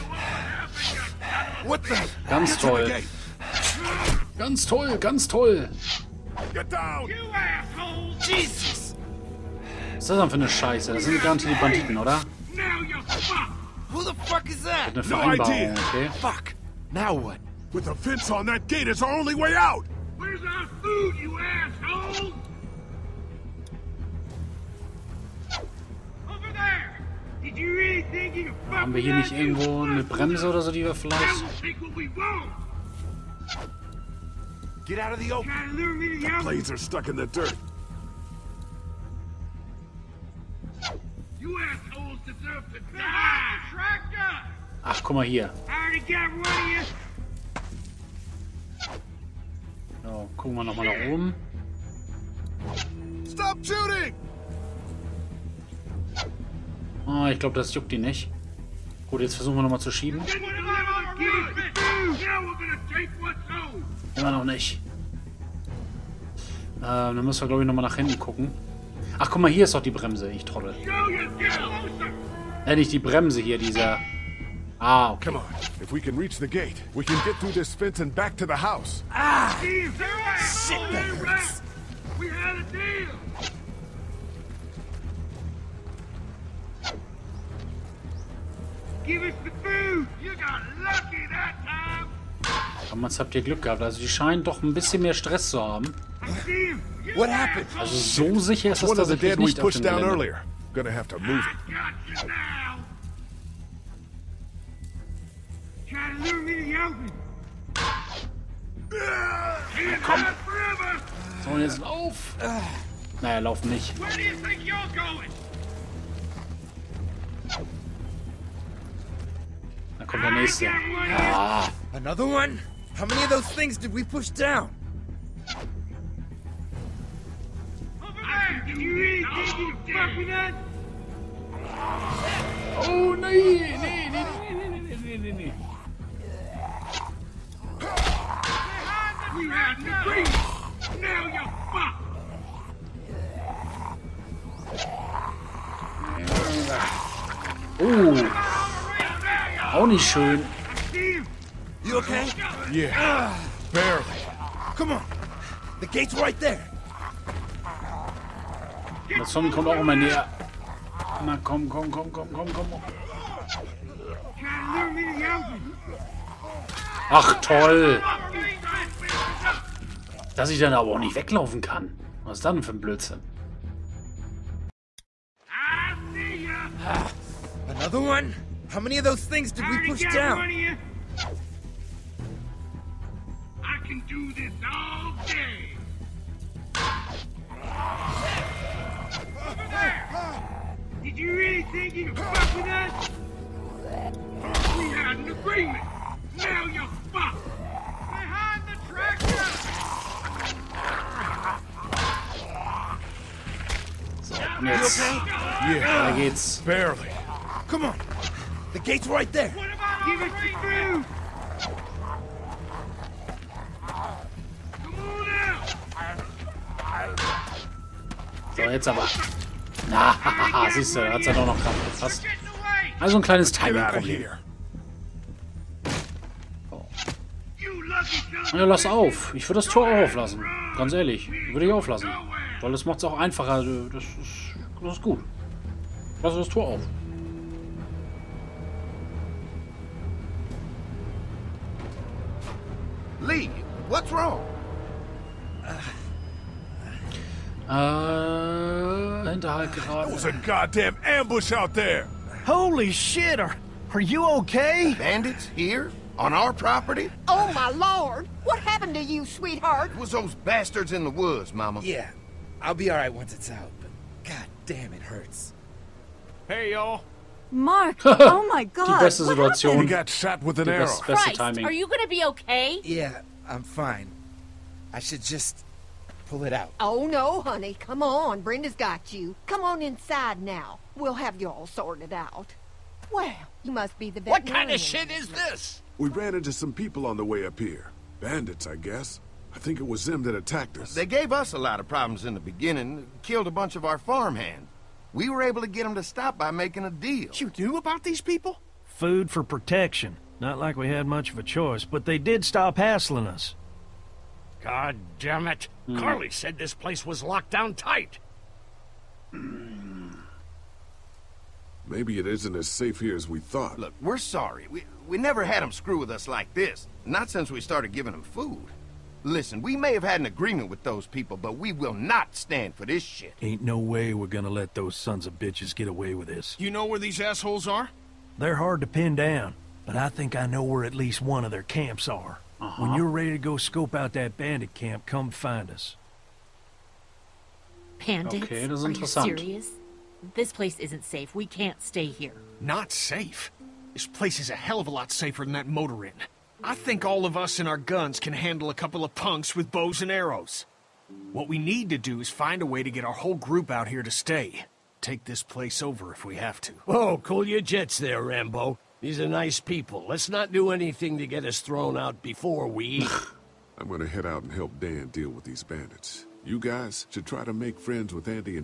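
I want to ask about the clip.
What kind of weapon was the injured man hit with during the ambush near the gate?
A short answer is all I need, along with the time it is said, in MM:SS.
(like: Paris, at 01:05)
An arrow, at 04:30.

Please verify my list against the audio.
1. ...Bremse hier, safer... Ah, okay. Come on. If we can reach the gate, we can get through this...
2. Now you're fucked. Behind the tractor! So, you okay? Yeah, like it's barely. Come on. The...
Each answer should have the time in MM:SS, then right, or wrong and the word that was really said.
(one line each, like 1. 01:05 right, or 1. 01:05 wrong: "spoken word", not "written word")
1. 01:12 wrong: "dieser", not "safer"
2. 03:16 right.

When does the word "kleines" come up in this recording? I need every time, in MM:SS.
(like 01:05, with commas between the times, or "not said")
03:43.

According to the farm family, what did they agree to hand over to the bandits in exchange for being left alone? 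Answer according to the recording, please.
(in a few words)
Food for protection.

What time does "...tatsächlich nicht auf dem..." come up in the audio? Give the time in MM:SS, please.
01:38.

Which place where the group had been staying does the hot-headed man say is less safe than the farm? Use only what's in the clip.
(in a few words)
Motor inn.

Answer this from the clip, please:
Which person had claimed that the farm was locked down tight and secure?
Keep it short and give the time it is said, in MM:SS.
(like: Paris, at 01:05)
Carley, at 05:05.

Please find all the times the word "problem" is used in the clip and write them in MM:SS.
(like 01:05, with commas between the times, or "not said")
03:43, 04:51.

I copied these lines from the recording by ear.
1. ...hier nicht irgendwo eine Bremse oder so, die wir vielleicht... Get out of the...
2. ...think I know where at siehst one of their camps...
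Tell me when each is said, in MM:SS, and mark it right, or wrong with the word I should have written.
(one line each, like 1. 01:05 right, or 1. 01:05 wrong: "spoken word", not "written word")
1. 00:29 right
2. 05:30 wrong: "least", not "siehst".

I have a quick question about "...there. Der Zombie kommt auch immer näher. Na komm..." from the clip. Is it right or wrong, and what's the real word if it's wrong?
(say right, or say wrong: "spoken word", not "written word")
right.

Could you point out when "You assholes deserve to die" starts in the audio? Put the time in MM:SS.
00:41.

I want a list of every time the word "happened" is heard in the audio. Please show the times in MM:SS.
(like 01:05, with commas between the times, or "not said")
04:18, 04:29.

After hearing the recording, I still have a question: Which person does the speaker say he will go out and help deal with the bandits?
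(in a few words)
Dan.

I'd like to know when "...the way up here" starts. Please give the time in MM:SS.
04:47.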